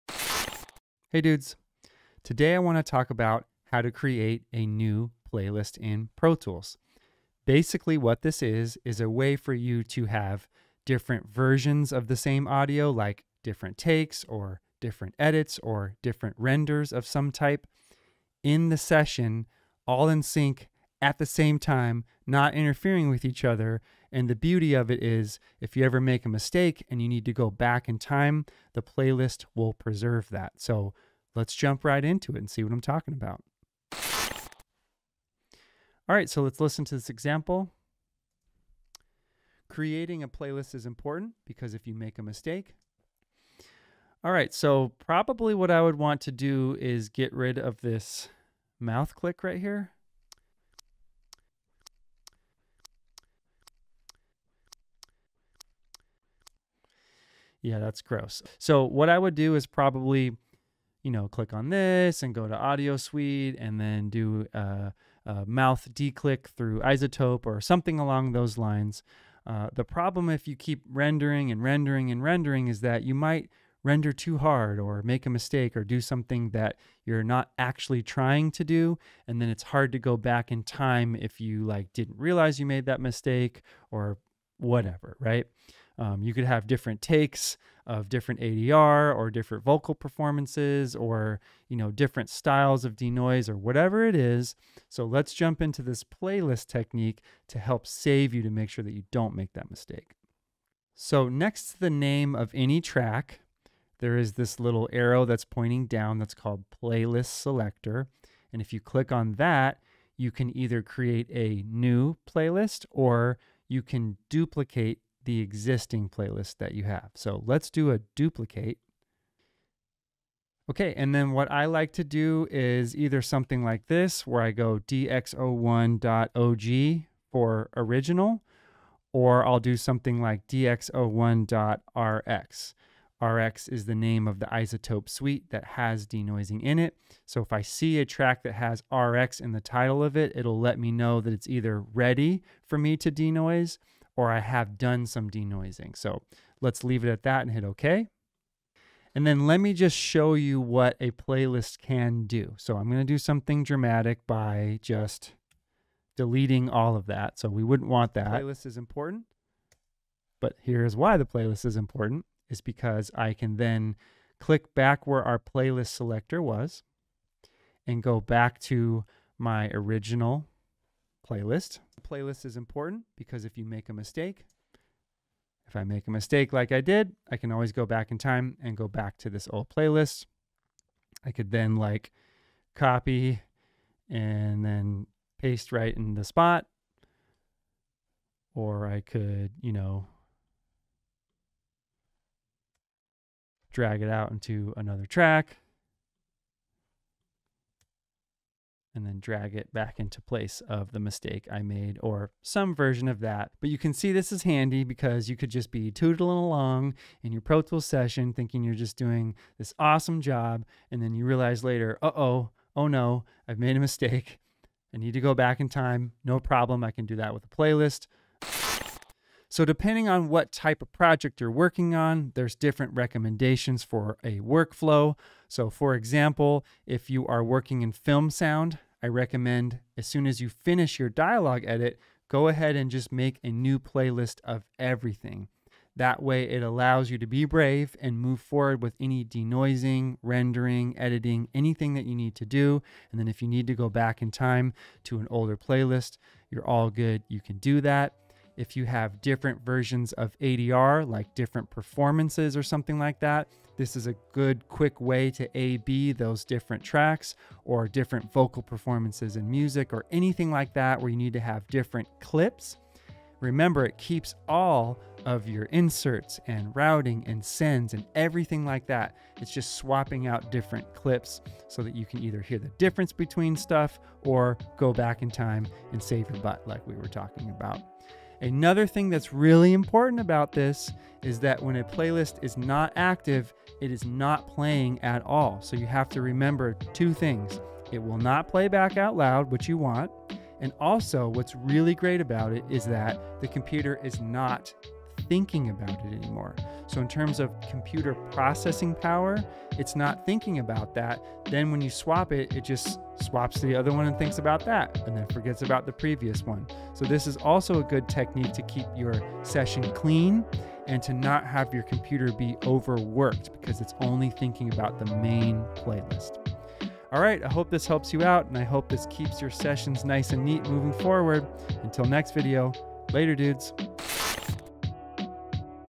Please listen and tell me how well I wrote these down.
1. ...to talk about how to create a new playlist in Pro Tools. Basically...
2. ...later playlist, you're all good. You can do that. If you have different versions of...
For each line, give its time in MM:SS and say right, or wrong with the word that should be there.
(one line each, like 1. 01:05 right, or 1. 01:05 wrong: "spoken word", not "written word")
1. 00:02 right
2. 04:05 wrong: "older", not "later".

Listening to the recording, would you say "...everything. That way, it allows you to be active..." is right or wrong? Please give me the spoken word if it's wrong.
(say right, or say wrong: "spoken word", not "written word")
wrong: "brave", not "active".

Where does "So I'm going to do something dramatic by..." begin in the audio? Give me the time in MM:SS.
02:32.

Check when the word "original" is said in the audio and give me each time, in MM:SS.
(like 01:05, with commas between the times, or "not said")
02:07, 02:49.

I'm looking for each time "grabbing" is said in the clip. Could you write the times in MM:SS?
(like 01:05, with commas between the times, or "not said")
not said.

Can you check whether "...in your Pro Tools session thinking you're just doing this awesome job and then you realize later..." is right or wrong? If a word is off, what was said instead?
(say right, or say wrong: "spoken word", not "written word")
right.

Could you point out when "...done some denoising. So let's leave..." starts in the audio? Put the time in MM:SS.
02:24.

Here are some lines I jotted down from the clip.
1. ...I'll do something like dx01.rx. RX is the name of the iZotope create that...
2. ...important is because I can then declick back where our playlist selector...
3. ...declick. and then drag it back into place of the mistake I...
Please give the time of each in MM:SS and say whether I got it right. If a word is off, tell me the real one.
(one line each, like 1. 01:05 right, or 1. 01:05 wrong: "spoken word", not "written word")
1. 02:09 wrong: "suite", not "create"
2. 02:41 wrong: "click", not "declick"
3. 03:15 wrong: "track", not "declick".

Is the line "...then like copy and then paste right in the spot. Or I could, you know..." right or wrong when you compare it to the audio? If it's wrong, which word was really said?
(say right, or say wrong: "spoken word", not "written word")
right.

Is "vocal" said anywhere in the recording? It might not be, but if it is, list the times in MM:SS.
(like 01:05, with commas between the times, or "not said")
01:29, 04:18.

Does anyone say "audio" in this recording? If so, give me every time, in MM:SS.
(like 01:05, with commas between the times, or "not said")
00:12, 01:02.